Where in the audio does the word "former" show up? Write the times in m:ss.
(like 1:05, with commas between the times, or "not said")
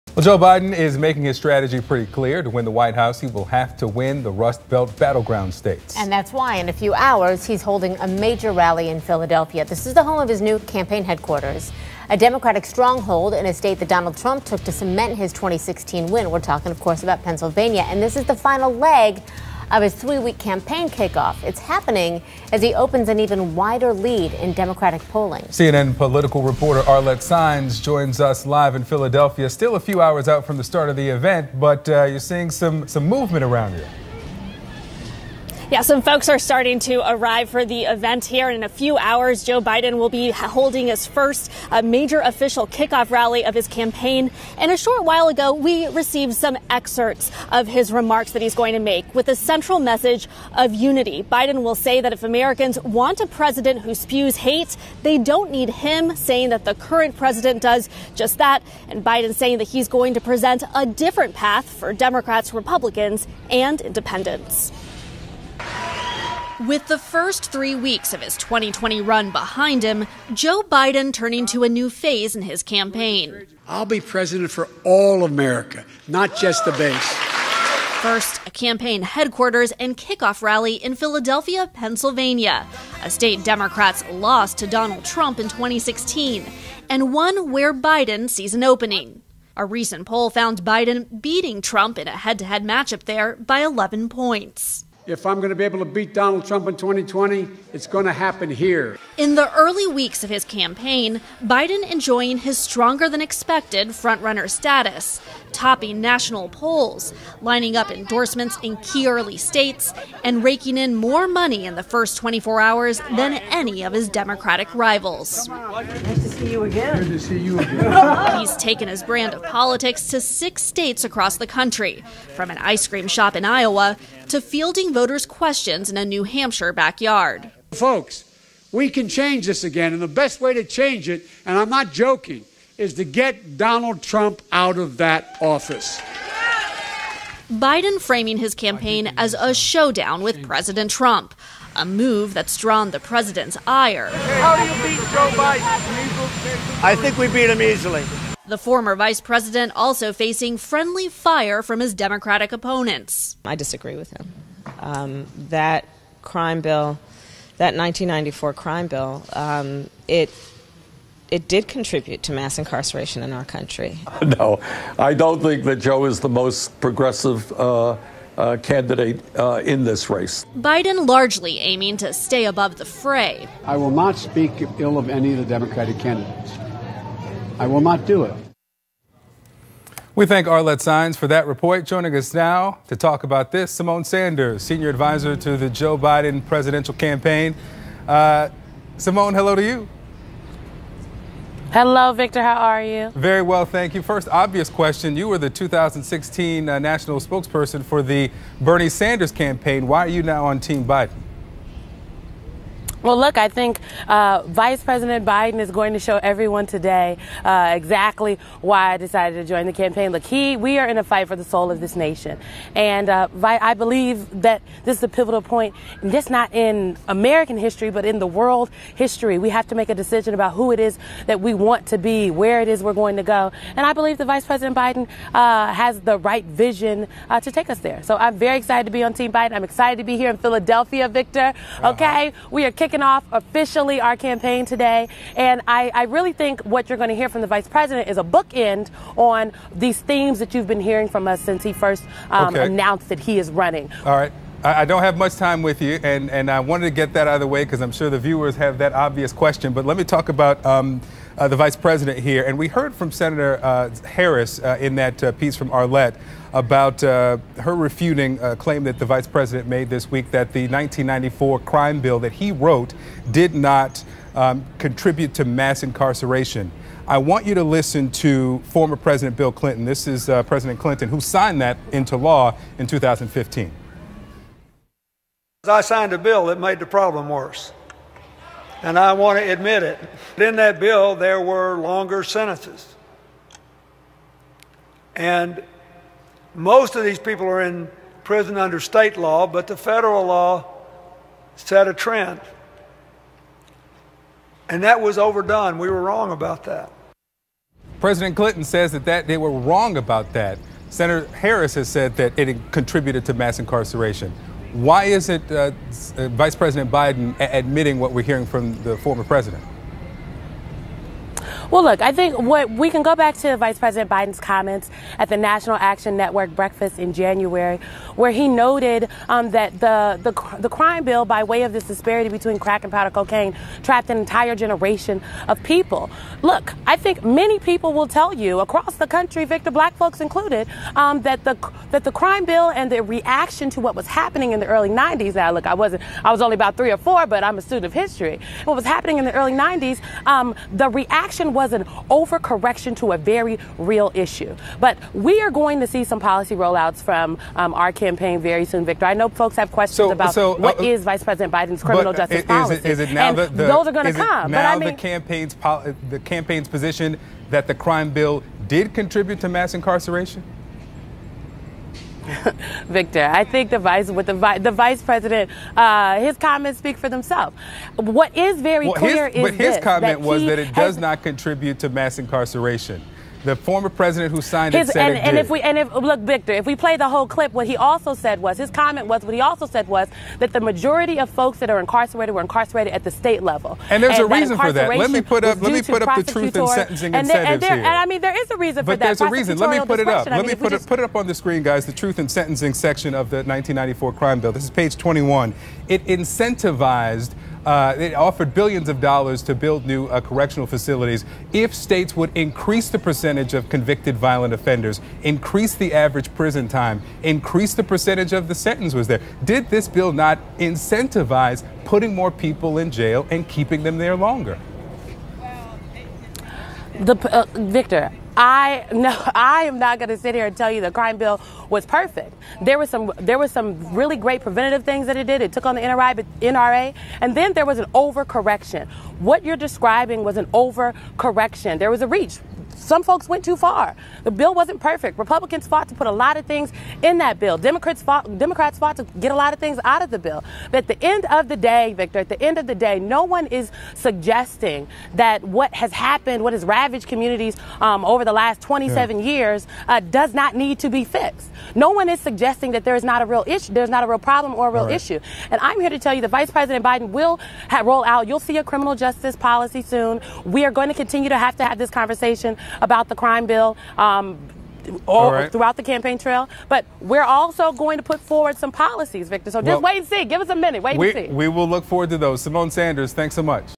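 2:28, 4:28, 5:08, 6:13.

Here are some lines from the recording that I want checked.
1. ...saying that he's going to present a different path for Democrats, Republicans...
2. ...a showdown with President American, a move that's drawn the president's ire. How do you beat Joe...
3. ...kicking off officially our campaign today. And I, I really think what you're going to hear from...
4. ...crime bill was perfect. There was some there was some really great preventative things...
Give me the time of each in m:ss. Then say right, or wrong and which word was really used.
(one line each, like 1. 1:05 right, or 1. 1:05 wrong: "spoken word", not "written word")
1. 0:59 right
2. 2:19 wrong: "Trump", not "American"
3. 3:52 right
4. 7:00 right.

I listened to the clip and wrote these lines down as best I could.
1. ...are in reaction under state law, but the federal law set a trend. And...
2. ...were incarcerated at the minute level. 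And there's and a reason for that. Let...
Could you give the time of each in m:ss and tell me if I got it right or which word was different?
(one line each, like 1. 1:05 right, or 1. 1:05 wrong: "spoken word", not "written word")
1. 4:47 wrong: "prison", not "reaction"
2. 6:22 wrong: "state", not "minute".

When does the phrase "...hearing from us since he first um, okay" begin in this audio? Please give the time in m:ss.
4:00.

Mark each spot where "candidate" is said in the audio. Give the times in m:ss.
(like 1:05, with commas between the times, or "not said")
2:48, 2:55.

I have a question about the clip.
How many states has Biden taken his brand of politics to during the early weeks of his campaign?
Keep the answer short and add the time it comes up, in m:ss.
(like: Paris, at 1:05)
6, at 2:00.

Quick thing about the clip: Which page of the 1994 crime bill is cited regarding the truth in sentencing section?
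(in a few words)
21.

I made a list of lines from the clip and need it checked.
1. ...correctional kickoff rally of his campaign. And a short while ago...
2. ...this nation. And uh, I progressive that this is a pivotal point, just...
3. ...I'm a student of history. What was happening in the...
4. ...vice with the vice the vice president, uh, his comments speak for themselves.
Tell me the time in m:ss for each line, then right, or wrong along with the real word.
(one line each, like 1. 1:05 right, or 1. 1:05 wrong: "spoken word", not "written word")
1. 0:42 wrong: "official", not "correctional"
2. 3:31 wrong: "believe", not "progressive"
3. 5:37 right
4. 6:03 right.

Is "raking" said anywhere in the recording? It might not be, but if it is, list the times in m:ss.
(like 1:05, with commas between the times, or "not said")
1:50.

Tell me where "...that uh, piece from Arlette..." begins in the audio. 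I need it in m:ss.
4:14.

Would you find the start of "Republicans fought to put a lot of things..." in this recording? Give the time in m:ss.
7:15.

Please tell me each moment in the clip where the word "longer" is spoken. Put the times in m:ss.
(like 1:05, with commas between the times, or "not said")
4:41, 6:54.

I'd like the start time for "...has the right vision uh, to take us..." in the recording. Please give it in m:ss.
3:45.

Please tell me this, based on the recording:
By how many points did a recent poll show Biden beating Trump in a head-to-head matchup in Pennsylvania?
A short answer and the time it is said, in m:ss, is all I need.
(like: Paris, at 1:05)
11, at 1:33.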